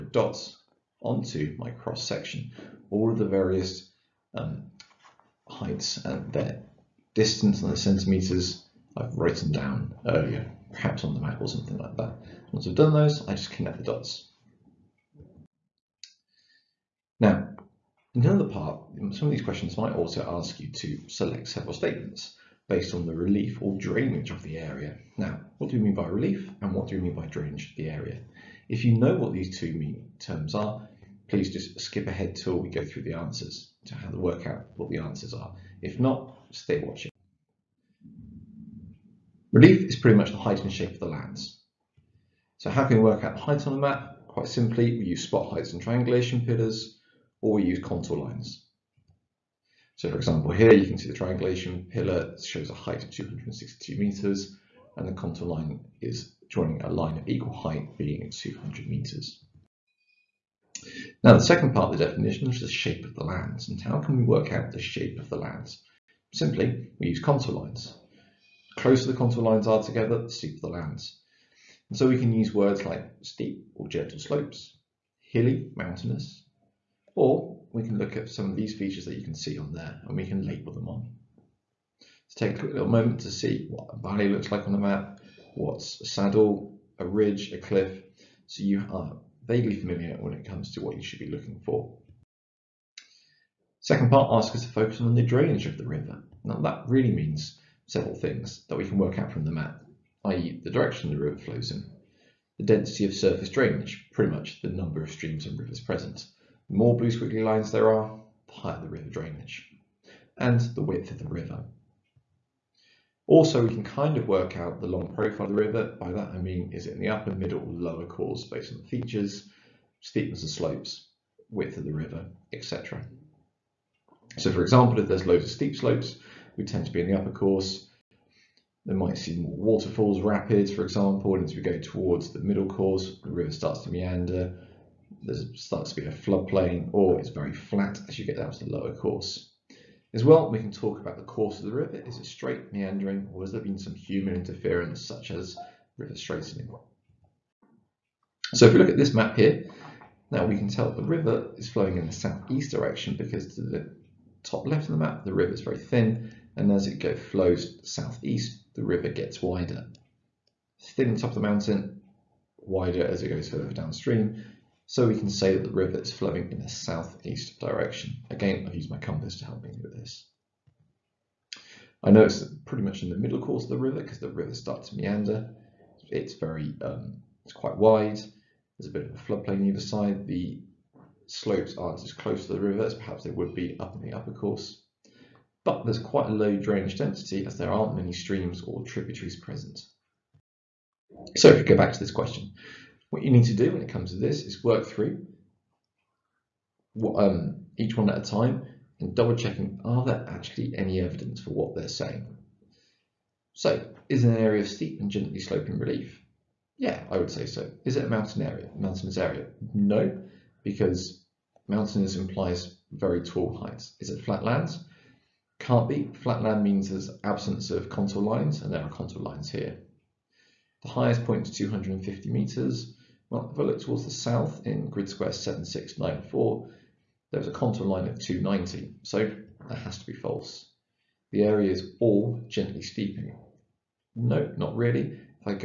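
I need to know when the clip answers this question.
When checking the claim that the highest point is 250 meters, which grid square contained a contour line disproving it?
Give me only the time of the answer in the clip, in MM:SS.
03:45.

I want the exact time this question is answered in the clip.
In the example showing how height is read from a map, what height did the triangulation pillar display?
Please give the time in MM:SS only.
00:53.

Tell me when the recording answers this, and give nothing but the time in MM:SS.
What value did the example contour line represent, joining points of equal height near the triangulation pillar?
00:58.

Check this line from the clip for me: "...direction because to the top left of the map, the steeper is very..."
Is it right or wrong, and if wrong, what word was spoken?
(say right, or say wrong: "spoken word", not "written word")
wrong: "river", not "steeper".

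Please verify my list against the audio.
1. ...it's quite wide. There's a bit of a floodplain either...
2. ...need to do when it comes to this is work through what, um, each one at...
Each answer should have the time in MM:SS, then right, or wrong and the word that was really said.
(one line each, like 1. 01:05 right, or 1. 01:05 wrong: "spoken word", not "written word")
1. 02:57 right
2. 03:13 right.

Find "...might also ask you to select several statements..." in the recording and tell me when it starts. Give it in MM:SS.
00:19.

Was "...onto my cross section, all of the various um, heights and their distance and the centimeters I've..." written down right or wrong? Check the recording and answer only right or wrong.
right.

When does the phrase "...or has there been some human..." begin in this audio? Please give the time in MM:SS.
02:23.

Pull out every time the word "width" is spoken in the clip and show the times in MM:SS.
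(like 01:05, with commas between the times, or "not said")
01:50, 02:01.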